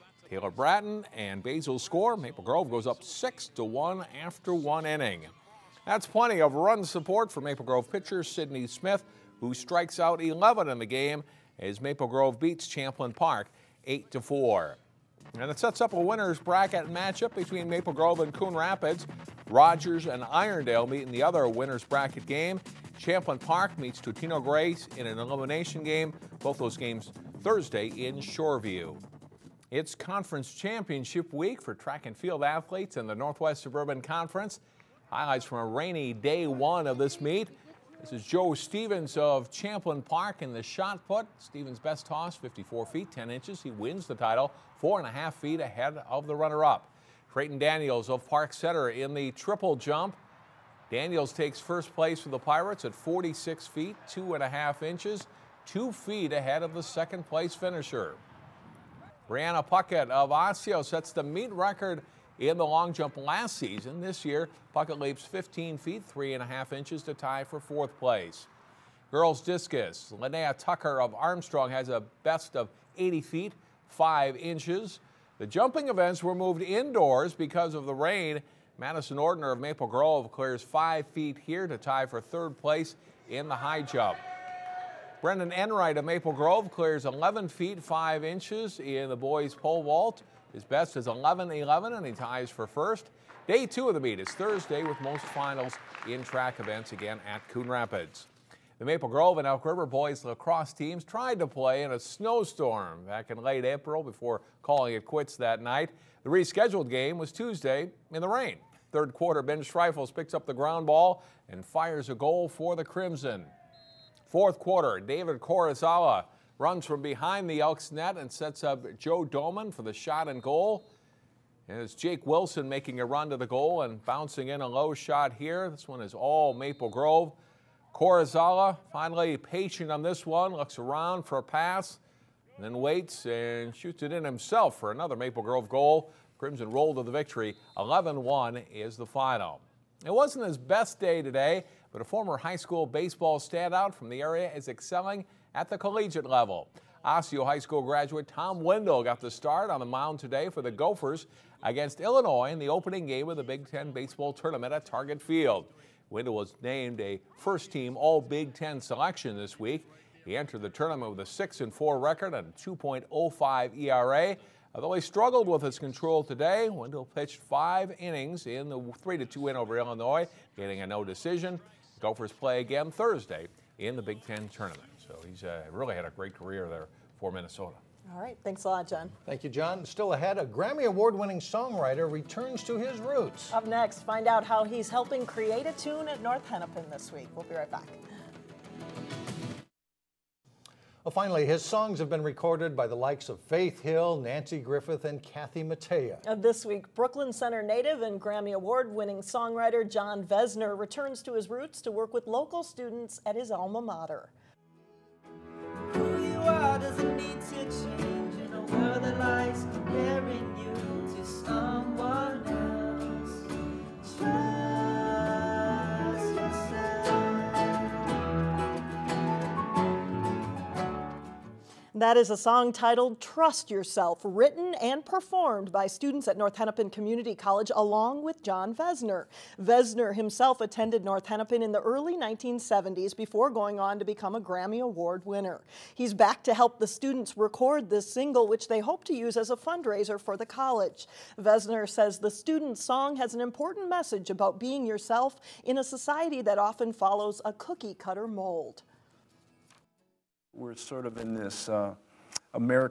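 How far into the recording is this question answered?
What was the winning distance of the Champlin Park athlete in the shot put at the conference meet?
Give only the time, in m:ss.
0:42.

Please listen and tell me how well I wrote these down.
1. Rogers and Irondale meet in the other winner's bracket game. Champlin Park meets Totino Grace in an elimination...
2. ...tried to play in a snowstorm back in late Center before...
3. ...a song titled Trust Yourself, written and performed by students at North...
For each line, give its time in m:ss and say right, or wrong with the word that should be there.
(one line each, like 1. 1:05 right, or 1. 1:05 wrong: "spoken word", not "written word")
1. 0:19 right
2. 1:41 wrong: "April", not "Center"
3. 3:42 right.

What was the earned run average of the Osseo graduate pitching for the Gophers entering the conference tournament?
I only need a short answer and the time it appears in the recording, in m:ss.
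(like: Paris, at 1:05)
2.05, at 2:42.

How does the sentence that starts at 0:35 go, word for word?
Highlights from a rainy day one of this meet.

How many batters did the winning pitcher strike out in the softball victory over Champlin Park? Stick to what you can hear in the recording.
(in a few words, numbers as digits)
11.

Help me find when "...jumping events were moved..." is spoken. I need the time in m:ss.
1:15.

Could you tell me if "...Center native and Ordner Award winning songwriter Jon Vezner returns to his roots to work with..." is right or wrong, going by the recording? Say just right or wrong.
wrong.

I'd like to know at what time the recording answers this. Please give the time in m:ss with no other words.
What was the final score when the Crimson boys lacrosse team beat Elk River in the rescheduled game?
2:17.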